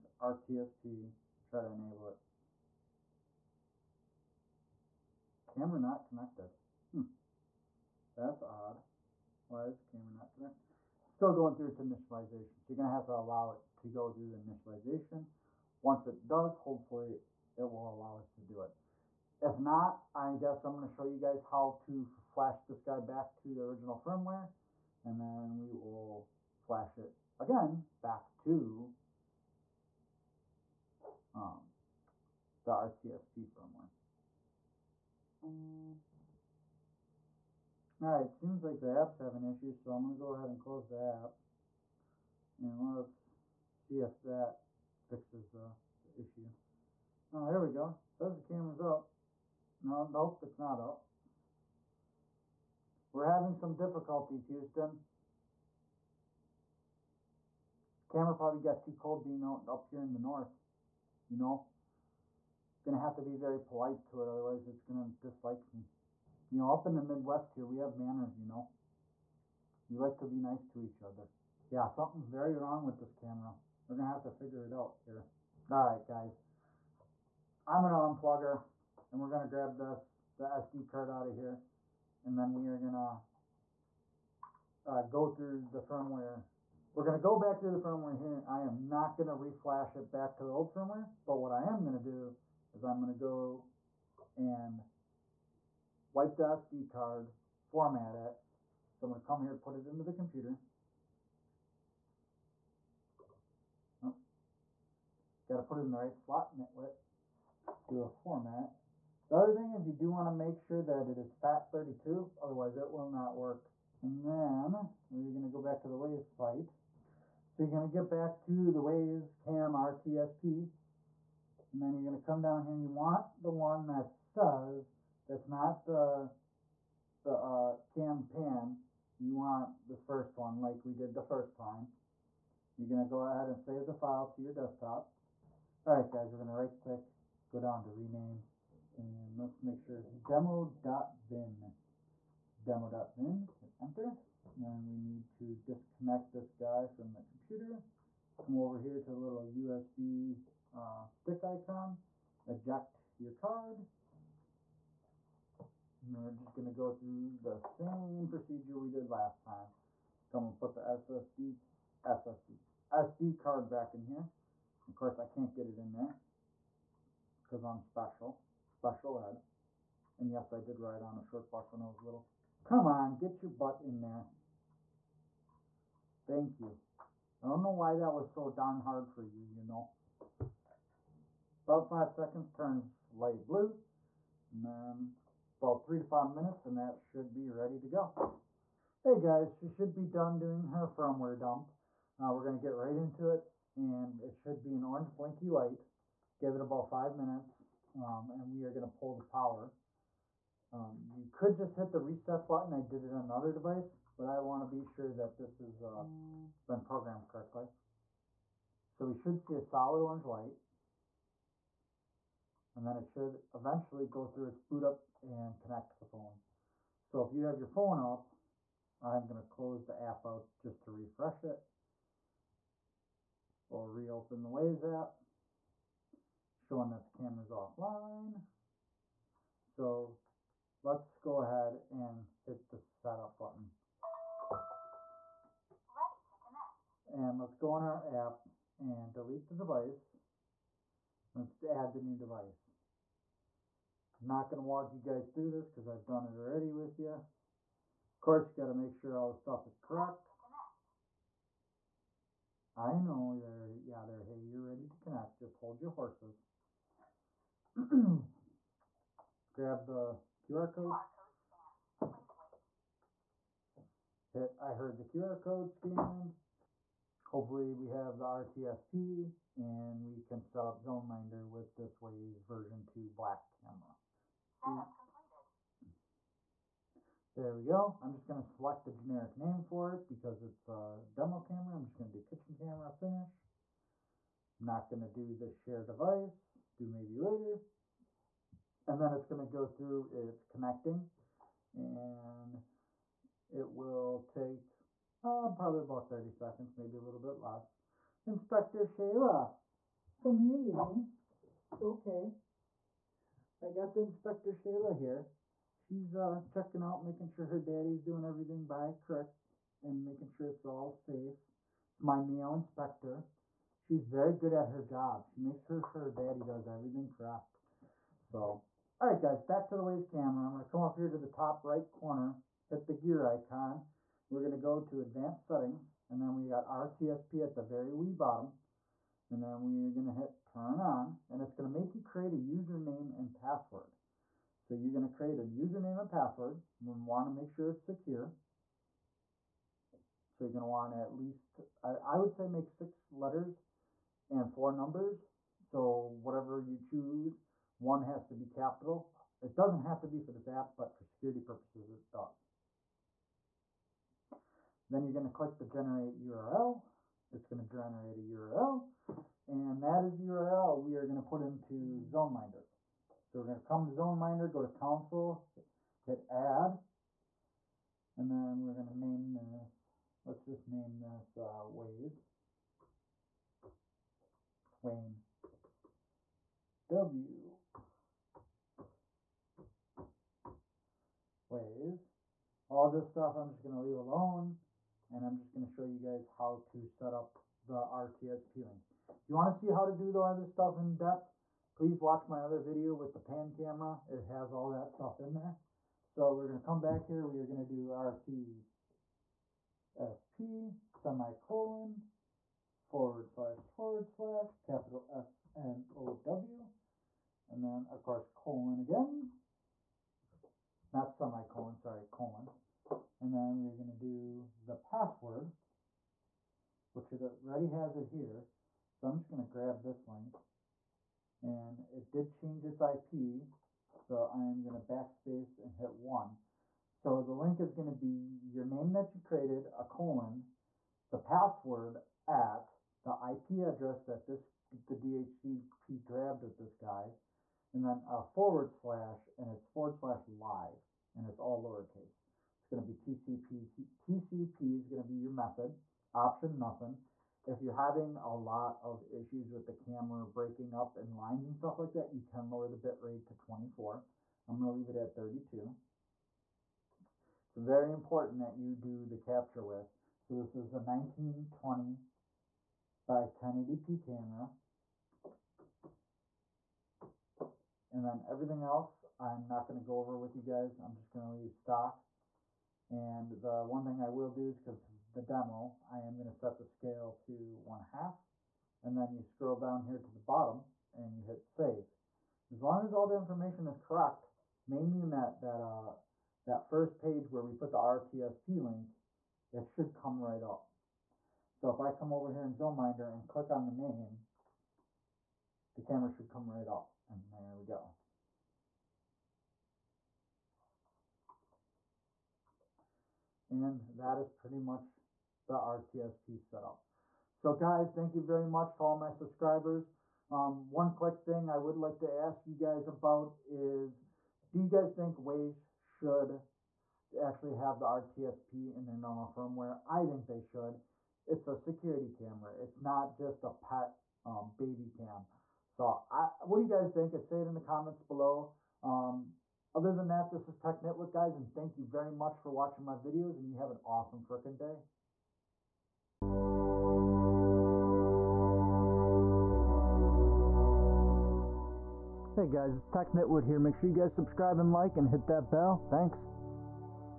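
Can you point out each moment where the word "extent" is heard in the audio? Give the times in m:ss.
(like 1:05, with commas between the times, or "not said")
not said.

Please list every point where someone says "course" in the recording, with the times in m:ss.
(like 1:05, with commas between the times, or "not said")
2:44, 4:08, 6:48.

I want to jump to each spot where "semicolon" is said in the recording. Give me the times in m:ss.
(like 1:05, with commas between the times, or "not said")
6:40, 6:51.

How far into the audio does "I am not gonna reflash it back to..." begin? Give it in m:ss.
1:28.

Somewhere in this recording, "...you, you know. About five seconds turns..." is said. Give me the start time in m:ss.
2:59.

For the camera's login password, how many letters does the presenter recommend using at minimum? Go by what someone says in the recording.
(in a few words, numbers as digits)
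6.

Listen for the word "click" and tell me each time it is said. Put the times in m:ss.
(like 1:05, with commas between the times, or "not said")
2:16, 5:55, 8:13.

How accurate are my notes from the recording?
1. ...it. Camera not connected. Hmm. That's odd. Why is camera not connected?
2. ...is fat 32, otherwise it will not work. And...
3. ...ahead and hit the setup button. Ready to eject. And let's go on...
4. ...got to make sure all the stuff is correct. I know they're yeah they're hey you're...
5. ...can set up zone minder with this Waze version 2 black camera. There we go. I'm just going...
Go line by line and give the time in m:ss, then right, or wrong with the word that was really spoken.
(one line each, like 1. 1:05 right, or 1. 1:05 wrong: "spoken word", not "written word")
1. 0:02 right
2. 1:51 right
3. 3:51 wrong: "connect", not "eject"
4. 4:08 right
5. 4:30 right.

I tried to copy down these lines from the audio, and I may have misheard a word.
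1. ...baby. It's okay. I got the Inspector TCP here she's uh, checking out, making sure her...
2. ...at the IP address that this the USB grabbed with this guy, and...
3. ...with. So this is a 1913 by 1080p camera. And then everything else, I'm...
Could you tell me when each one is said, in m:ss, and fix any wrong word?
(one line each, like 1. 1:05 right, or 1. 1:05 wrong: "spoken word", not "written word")
1. 5:00 wrong: "Shayla", not "TCP"
2. 7:12 wrong: "DHCP", not "USB"
3. 7:39 wrong: "1920", not "1913".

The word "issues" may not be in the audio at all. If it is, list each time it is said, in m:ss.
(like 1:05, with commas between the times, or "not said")
0:39, 0:46, 7:29.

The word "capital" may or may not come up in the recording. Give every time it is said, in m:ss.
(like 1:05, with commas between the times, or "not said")
5:48, 6:44.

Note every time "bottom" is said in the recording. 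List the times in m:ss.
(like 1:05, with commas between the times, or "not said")
5:28, 8:00.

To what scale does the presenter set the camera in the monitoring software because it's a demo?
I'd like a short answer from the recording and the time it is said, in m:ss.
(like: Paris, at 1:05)
One half, at 7:57.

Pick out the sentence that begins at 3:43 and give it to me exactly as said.
Or reopen the Wyze app showing that the camera's offline.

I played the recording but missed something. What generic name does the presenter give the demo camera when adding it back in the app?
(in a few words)
Kitchen camera.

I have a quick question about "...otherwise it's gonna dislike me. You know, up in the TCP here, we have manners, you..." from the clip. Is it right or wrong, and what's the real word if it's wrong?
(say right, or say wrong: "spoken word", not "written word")
wrong: "Midwest", not "TCP".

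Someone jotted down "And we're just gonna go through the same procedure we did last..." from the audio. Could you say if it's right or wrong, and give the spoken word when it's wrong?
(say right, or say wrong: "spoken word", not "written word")
right.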